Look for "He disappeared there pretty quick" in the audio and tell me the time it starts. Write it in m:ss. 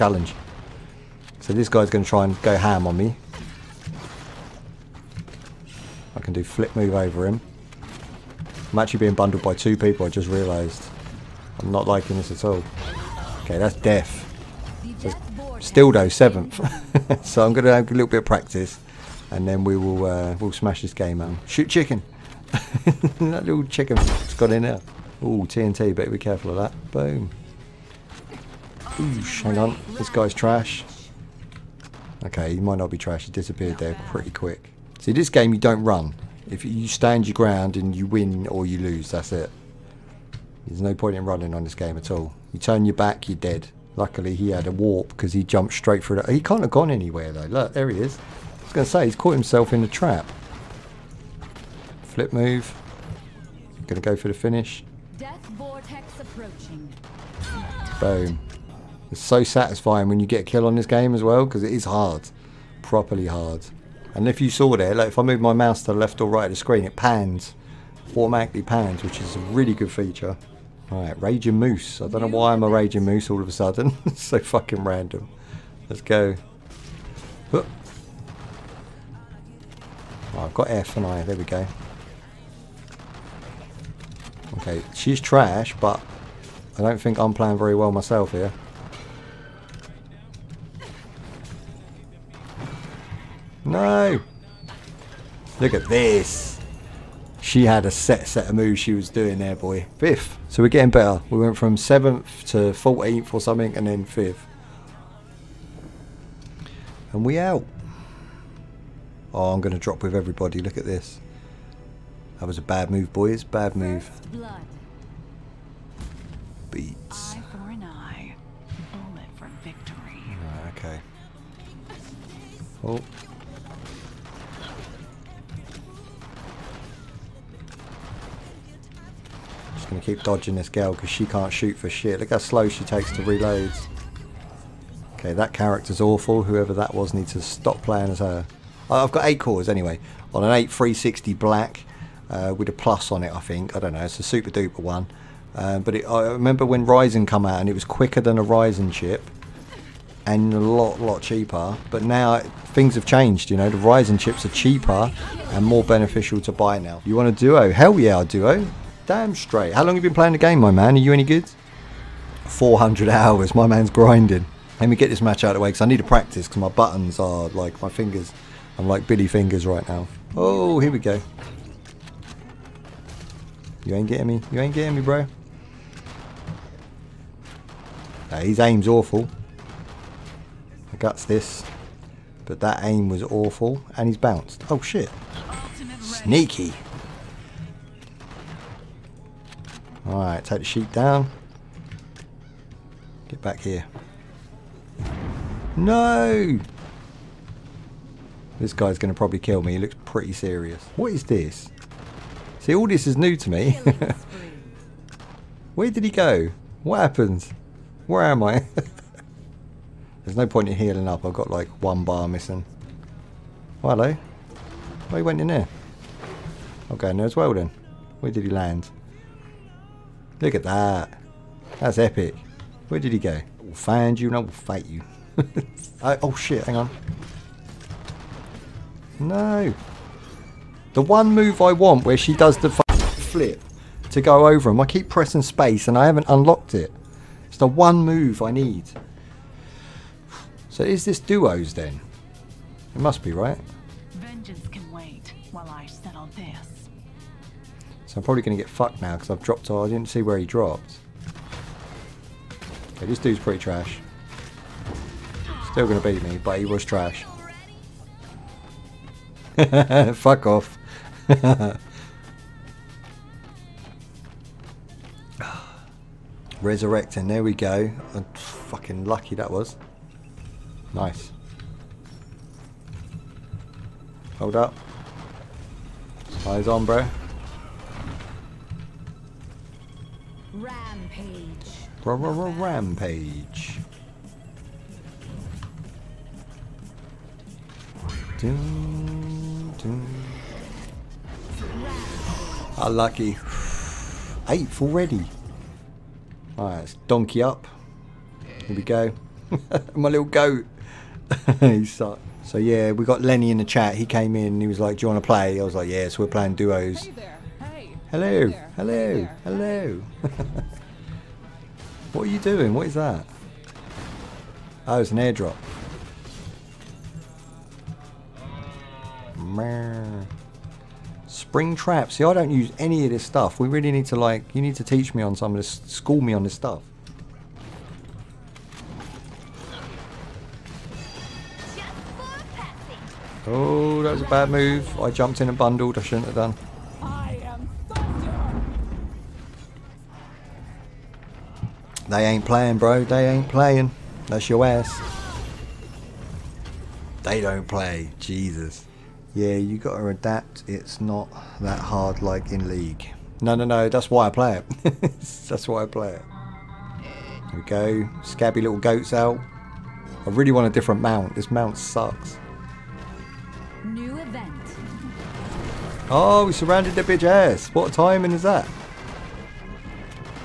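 0:33.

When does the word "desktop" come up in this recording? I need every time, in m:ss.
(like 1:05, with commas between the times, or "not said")
not said.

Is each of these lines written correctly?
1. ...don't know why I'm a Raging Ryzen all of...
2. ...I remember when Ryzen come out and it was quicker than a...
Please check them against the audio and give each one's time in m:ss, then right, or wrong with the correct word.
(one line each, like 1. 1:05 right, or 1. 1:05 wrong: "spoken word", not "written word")
1. 1:12 wrong: "Moose", not "Ryzen"
2. 2:26 right.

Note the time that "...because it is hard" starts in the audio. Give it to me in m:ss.
1:01.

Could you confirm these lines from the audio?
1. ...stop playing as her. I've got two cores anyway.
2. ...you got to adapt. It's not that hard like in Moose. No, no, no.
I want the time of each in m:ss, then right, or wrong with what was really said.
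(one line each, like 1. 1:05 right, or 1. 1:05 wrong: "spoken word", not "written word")
1. 2:17 wrong: "eight", not "two"
2. 5:49 wrong: "League", not "Moose".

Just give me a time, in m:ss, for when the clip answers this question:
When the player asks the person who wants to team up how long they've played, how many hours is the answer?
2:42.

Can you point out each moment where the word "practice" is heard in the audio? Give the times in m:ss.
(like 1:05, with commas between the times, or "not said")
0:18, 2:46.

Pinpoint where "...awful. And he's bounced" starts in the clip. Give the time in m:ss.
3:03.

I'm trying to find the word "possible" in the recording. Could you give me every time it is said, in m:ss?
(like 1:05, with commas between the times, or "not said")
not said.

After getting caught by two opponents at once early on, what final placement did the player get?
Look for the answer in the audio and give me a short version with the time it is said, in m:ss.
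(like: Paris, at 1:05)
7th, at 0:16.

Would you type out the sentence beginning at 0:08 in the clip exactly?
I'm actually being bundled by two people, I just realised.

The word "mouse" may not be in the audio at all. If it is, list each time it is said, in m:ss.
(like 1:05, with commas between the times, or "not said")
1:05.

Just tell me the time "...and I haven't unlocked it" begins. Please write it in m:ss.
3:55.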